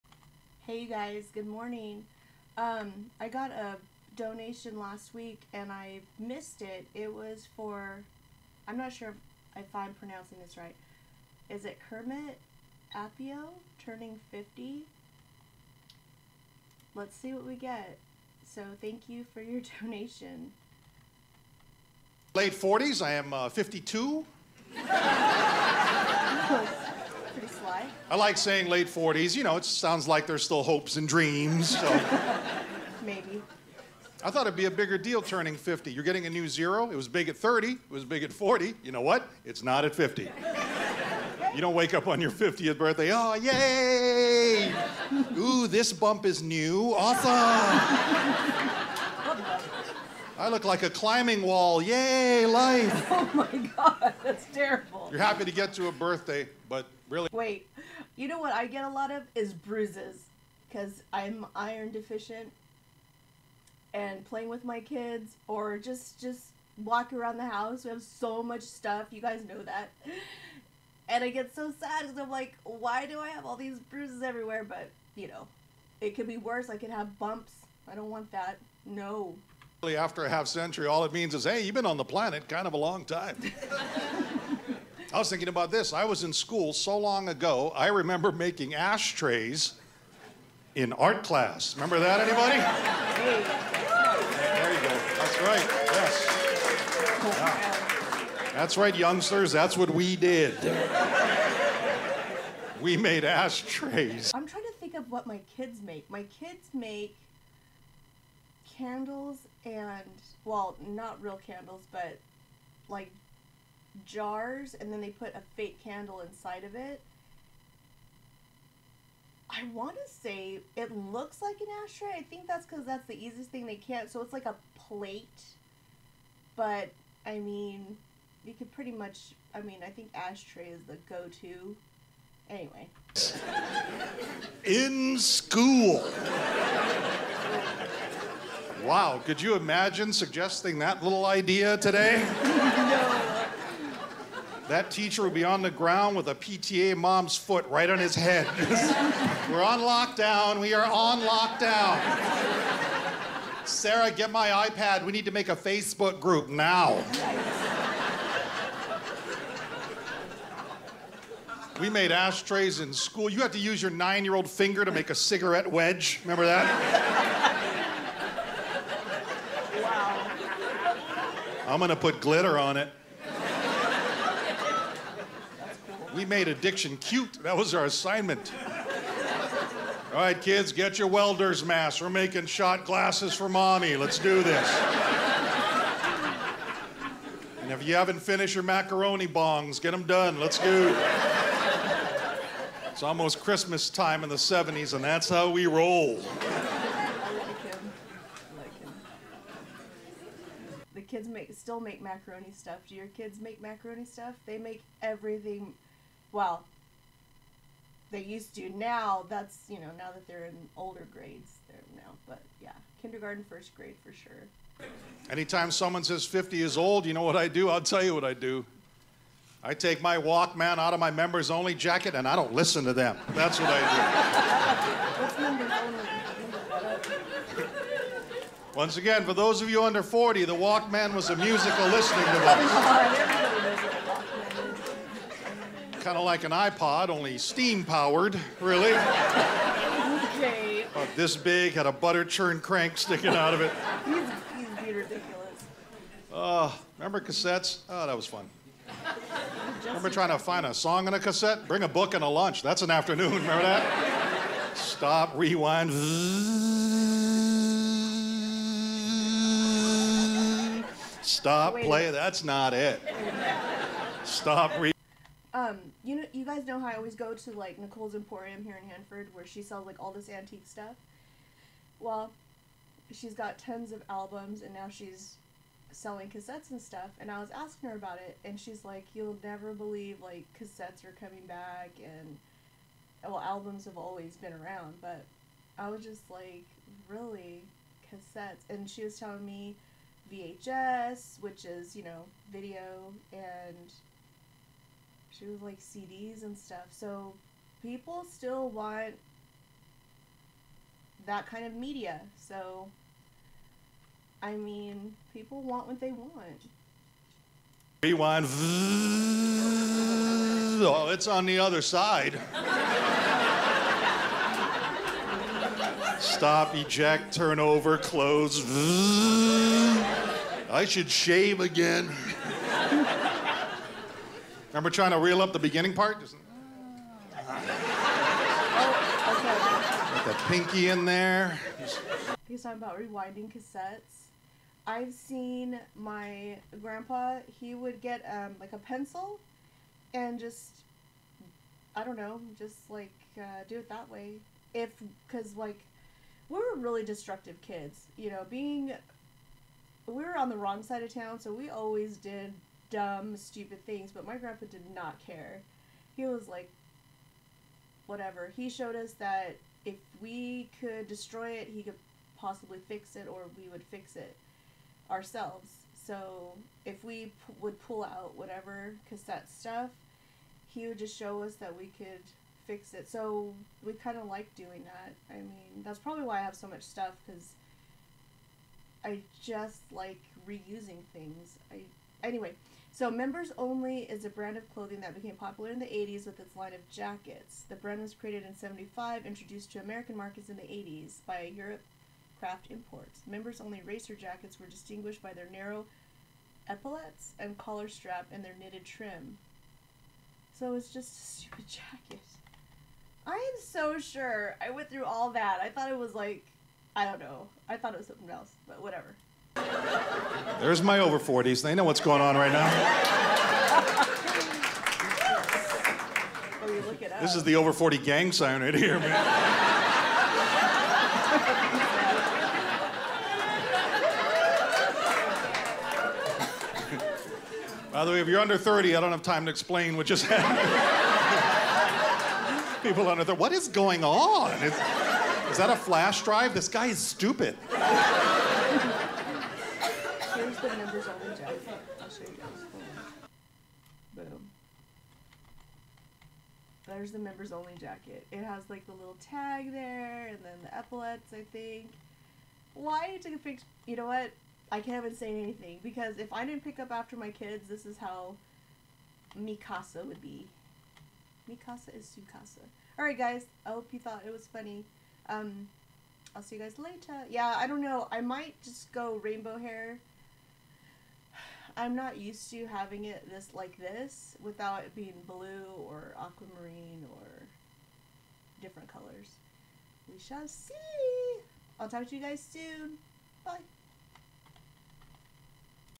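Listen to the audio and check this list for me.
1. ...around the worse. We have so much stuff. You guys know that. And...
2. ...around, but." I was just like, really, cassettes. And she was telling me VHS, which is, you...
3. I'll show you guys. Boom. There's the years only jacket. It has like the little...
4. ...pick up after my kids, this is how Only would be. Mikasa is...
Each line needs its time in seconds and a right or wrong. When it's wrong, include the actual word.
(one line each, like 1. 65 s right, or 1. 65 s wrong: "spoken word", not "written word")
1. 67 s wrong: "house", not "worse"
2. 284 s right
3. 442 s wrong: "members", not "years"
4. 456 s wrong: "Mikasa", not "Only".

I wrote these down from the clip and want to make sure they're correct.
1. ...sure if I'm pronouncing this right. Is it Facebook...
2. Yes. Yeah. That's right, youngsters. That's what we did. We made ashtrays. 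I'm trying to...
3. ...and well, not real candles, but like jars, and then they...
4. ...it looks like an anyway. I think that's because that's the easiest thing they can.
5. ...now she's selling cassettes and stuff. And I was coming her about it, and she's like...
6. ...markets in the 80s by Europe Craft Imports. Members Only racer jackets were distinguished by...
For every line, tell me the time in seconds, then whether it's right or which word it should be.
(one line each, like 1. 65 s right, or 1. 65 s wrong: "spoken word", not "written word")
1. 8 s wrong: "Kermet", not "Facebook"
2. 97 s right
3. 109 s right
4. 120 s wrong: "ashtray", not "anyway"
5. 274 s wrong: "asking", not "coming"
6. 390 s right.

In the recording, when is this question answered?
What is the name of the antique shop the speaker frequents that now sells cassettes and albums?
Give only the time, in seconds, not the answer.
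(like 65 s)
267 s.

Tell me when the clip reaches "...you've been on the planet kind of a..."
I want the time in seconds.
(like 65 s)
81 s.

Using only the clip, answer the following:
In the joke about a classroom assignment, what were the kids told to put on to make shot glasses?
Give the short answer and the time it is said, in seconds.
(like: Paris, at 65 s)
Welder's mask, at 181 s.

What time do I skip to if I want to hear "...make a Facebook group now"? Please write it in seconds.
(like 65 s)
155 s.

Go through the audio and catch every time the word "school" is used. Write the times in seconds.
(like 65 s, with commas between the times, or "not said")
86 s, 135 s, 162 s.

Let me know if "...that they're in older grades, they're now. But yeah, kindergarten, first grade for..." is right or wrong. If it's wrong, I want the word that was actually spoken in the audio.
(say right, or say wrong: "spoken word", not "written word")
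right.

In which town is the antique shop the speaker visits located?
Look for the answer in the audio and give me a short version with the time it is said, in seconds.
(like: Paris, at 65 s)
Hanford, at 268 s.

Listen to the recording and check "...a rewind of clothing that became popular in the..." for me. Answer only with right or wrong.
wrong.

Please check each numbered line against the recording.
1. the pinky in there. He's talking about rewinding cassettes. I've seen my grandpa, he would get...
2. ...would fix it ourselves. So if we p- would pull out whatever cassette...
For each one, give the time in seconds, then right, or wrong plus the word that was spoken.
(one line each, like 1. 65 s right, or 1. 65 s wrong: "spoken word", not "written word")
1. 330 s right
2. 363 s right.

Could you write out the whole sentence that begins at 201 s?
kids make still make macaroni stuff.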